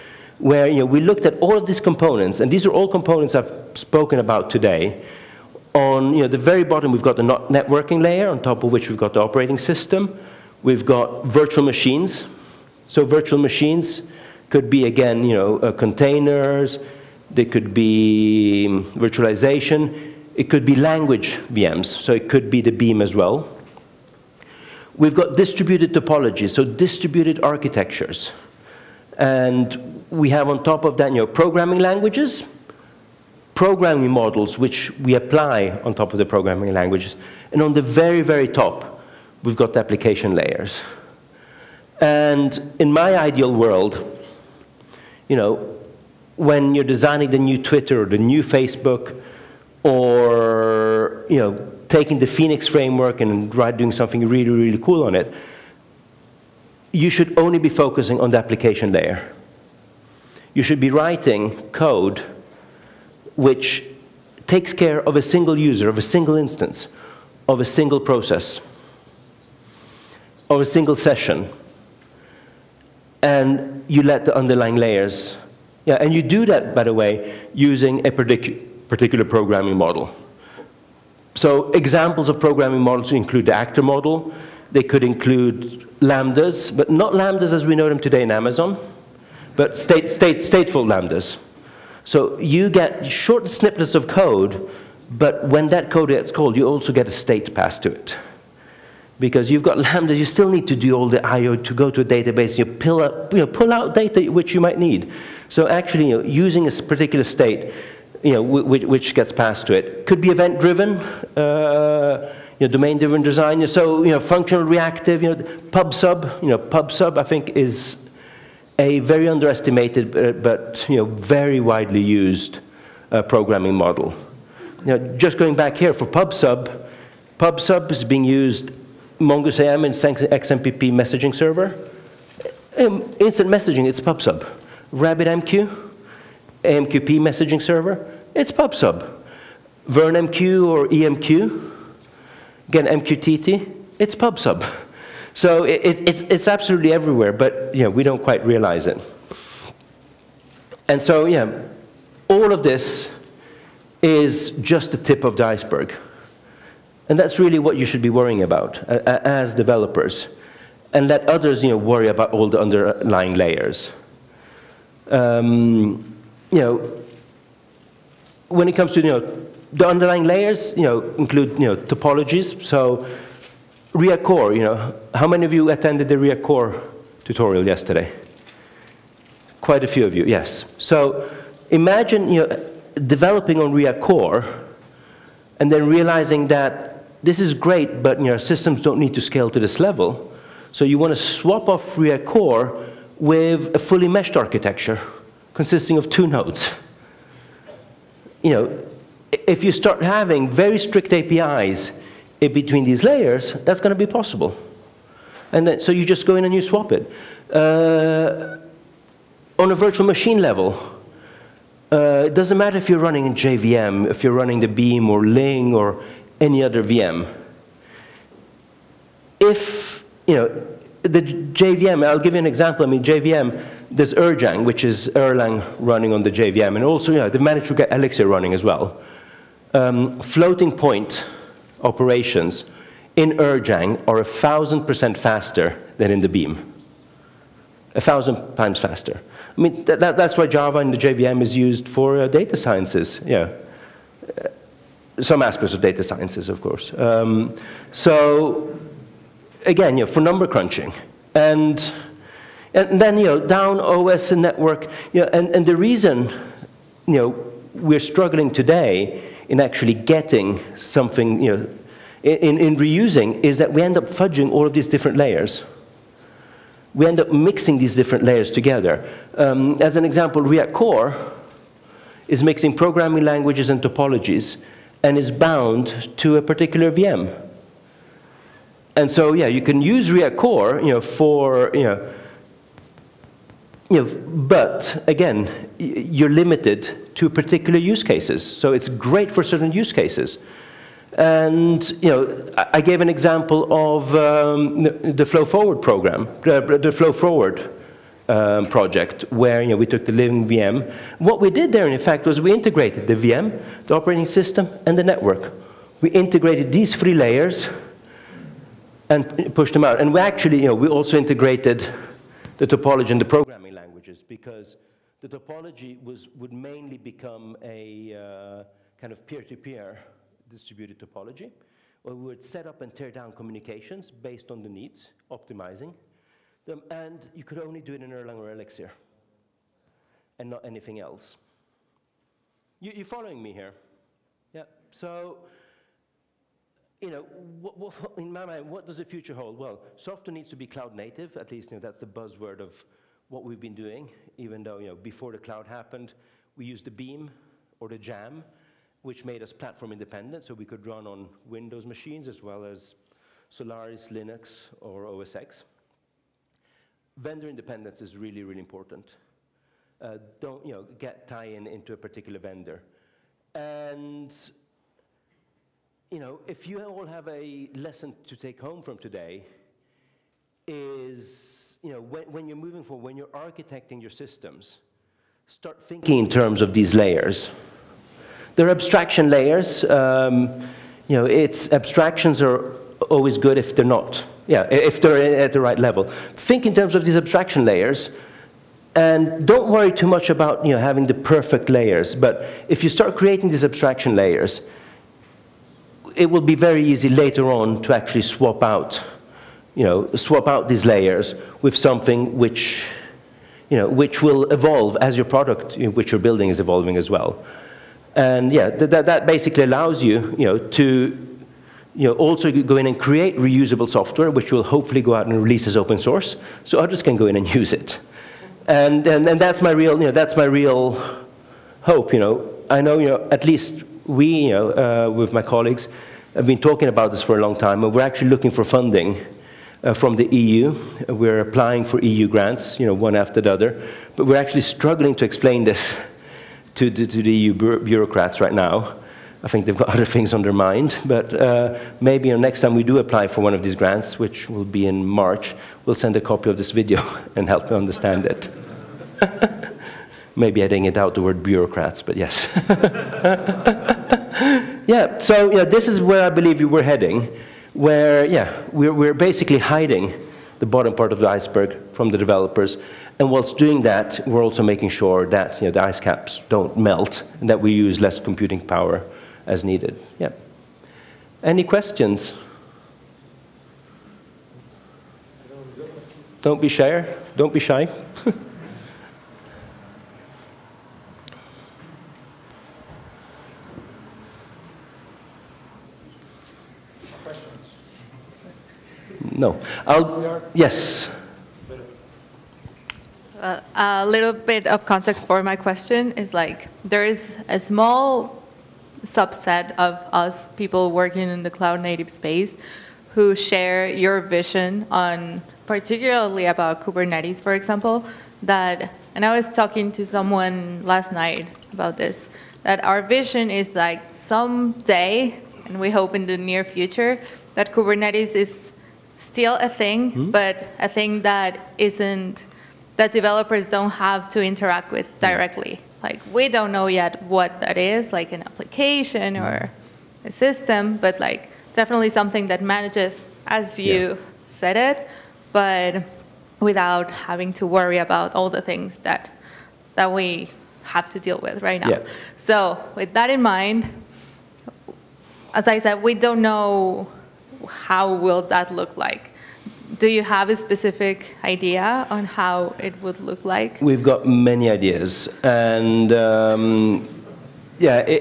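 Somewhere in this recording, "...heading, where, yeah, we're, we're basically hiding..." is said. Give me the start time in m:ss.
7:36.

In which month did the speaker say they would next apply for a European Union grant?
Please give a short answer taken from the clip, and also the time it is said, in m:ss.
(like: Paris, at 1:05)
March, at 7:25.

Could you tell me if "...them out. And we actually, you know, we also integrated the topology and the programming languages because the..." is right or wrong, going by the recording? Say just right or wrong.
right.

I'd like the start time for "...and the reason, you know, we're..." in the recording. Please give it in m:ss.
4:15.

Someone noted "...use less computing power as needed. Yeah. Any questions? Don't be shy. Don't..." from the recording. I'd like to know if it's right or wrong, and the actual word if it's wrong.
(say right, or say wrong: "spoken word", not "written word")
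right.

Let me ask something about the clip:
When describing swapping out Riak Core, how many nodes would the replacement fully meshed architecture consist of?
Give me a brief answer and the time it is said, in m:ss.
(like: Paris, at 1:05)
2, at 3:16.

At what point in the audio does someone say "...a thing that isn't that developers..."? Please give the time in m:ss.
8:40.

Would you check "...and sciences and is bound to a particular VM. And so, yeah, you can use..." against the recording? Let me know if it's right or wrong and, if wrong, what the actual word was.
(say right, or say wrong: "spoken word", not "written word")
wrong: "topologies", not "sciences".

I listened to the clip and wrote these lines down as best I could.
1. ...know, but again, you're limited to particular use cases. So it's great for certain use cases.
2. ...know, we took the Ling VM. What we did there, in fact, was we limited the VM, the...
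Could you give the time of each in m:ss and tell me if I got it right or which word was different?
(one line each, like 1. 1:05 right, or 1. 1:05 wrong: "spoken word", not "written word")
1. 4:44 right
2. 4:59 wrong: "integrated", not "limited".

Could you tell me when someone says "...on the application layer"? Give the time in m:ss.
0:58.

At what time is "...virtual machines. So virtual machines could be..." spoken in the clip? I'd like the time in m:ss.
0:11.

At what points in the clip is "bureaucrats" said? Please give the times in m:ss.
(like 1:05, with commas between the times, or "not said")
7:17, 7:31.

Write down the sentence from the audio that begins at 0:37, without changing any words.
And on the very, very top, we've got the application layers.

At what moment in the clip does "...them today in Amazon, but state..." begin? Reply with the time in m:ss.
1:27.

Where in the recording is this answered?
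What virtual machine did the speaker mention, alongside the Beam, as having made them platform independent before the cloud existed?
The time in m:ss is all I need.
5:47.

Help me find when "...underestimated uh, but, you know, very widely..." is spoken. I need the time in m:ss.
1:59.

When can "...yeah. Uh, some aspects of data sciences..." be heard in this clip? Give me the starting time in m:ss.
4:03.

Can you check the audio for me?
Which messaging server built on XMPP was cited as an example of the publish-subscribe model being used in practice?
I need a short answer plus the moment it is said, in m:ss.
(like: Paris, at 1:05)
MongooseIM, at 2:09.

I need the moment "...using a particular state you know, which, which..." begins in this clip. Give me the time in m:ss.
1:46.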